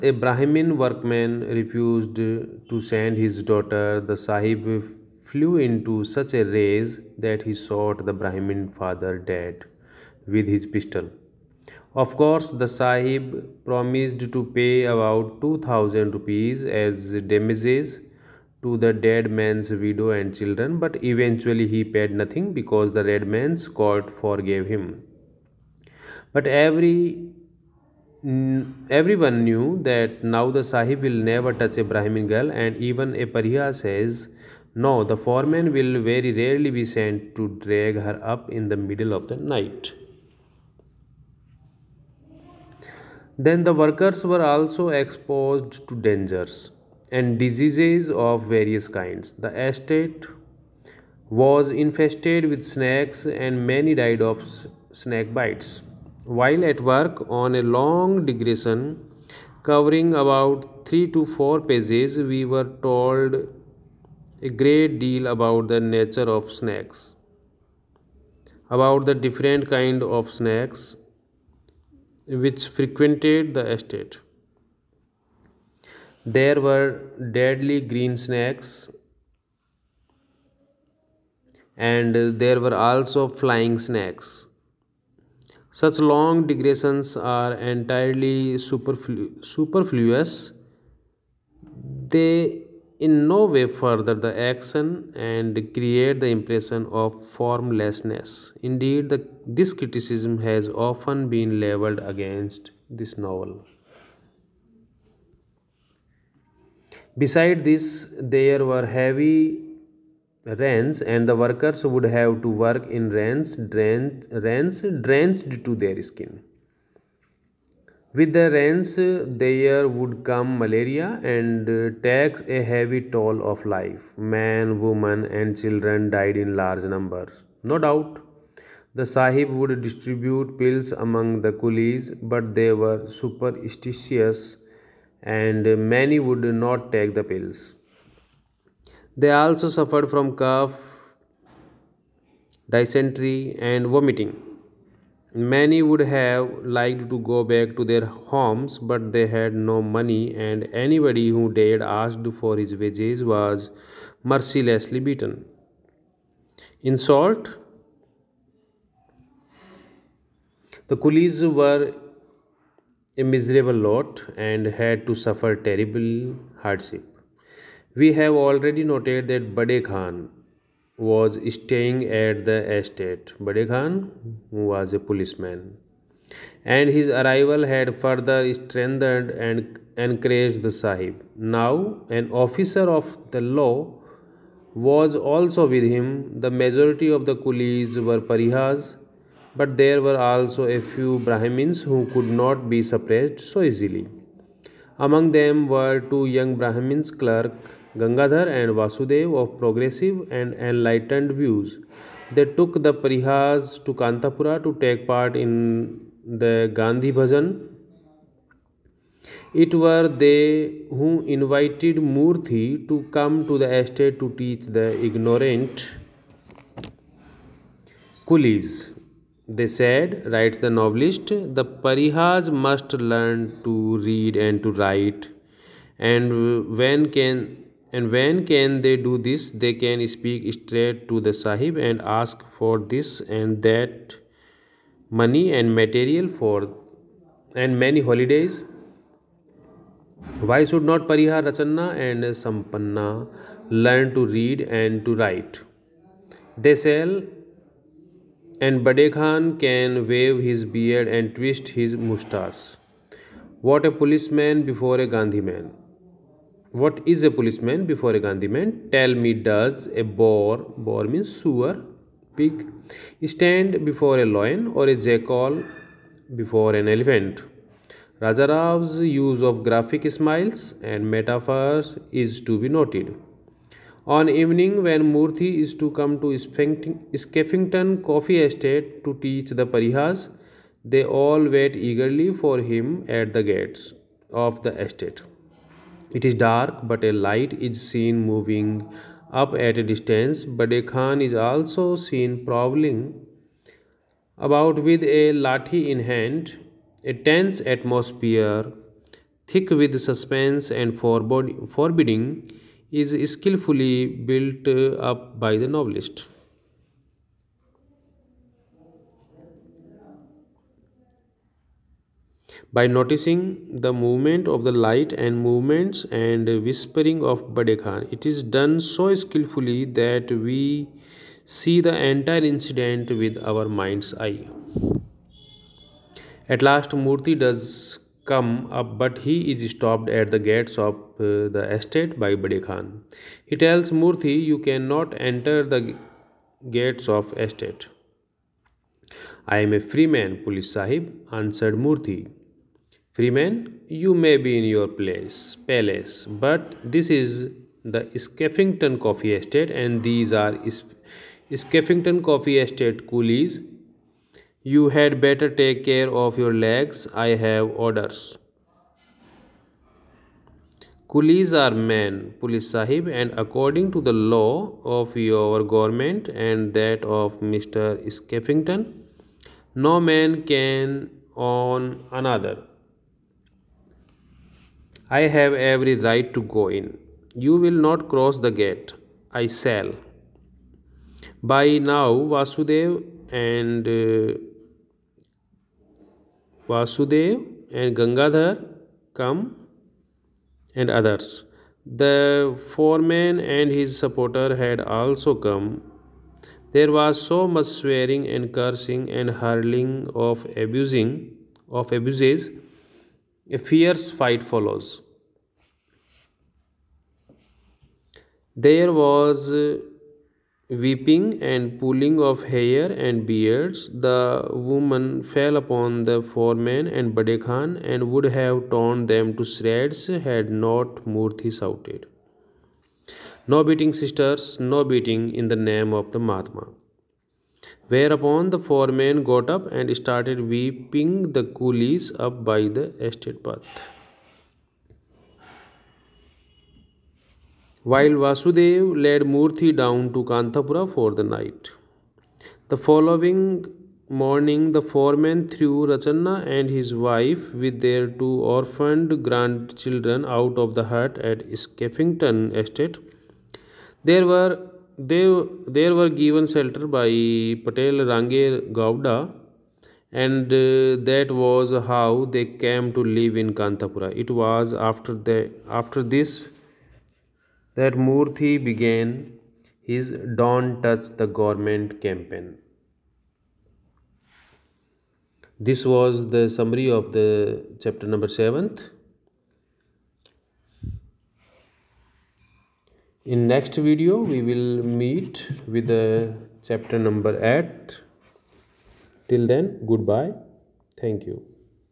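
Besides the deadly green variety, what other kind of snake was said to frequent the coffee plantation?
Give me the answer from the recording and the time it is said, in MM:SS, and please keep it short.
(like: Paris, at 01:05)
flying snakes, at 01:23.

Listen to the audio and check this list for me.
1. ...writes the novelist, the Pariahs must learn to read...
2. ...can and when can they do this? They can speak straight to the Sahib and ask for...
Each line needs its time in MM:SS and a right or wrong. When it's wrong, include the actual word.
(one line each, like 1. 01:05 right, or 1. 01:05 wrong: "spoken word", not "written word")
1. 03:40 right
2. 03:47 right.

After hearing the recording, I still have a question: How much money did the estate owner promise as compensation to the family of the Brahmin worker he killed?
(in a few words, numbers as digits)
2000 rupees.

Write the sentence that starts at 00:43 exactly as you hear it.
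Then the workers were also exposed to dangers and diseases of various kinds.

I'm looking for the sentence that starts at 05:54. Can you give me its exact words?
You had better take care of your legs.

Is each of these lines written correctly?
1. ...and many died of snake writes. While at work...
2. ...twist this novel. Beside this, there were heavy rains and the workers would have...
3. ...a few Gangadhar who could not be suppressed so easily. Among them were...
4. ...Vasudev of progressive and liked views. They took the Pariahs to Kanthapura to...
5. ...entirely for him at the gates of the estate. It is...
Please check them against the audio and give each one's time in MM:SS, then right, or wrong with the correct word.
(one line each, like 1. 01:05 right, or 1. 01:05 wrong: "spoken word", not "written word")
1. 00:53 wrong: "bites", not "writes"
2. 01:41 wrong: "against", not "twist"
3. 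03:10 wrong: "Brahmins", not "Gangadhar"
4. 03:18 wrong: "enlightened", not "liked"
5. 04:41 wrong: "eagerly", not "entirely".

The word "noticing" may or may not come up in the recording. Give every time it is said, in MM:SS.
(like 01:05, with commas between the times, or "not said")
05:12.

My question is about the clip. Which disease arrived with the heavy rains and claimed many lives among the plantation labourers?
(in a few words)
malaria.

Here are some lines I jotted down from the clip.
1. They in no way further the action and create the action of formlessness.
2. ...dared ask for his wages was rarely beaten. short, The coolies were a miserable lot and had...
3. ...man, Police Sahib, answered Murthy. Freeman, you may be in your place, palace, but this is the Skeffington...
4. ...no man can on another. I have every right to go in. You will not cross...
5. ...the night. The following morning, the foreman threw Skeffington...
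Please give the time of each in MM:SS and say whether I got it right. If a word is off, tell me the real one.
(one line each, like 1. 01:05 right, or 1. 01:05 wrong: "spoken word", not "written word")
1. 01:32 wrong: "impression", not "action"
2. 02:31 wrong: "mercilessly", not "rarely"
3. 05:40 right
4. 06:09 right
5. 07:21 wrong: "Rachanna", not "Skeffington".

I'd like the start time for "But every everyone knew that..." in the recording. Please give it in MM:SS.
00:26.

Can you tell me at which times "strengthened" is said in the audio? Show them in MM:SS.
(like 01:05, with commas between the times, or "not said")
02:58.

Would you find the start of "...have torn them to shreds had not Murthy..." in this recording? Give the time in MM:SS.
06:58.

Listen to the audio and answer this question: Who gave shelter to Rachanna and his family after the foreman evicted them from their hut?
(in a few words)
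Patel Range Gowda.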